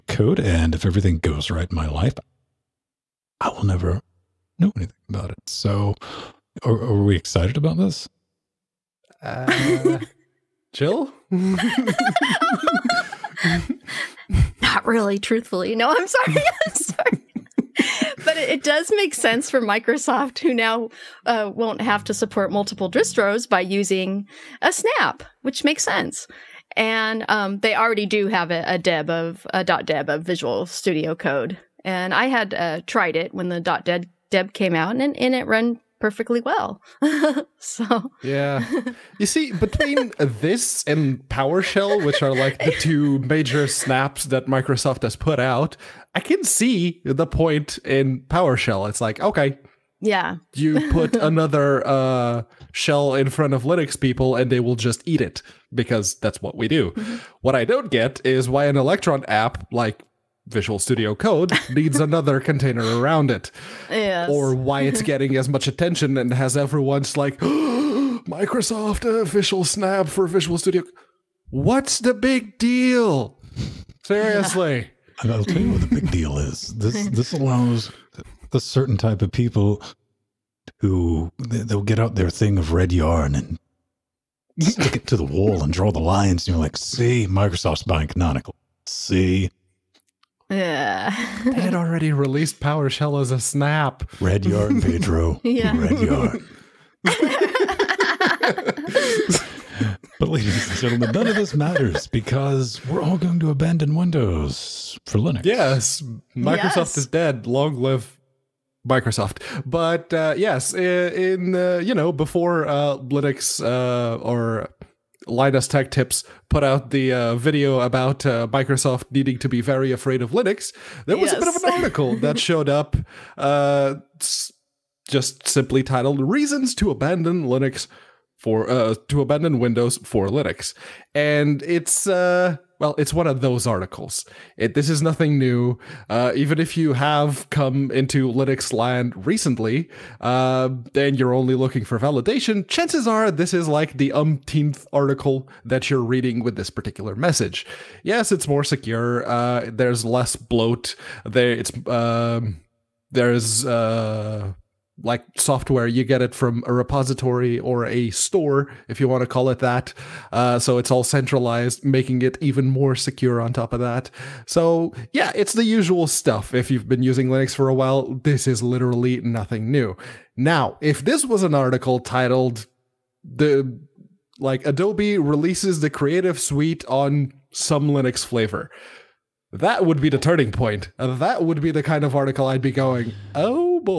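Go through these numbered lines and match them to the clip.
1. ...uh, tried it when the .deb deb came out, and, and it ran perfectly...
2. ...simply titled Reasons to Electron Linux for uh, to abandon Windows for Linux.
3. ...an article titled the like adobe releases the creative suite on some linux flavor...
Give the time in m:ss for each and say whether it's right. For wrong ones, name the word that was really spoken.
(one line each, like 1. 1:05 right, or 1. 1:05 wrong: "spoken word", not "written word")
1. 0:32 right
2. 2:05 wrong: "Abandon", not "Electron"
3. 2:51 right.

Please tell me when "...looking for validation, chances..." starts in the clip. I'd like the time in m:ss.
2:21.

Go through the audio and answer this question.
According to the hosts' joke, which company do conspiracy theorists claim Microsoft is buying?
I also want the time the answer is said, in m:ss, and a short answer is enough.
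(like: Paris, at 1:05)
Canonical, at 1:28.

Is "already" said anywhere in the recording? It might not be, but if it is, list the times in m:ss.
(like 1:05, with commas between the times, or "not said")
0:27, 1:31.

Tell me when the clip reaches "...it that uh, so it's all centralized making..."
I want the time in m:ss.
2:39.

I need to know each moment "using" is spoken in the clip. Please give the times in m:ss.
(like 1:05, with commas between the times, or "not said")
0:23, 2:47.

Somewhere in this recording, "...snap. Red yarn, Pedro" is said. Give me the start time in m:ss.
1:33.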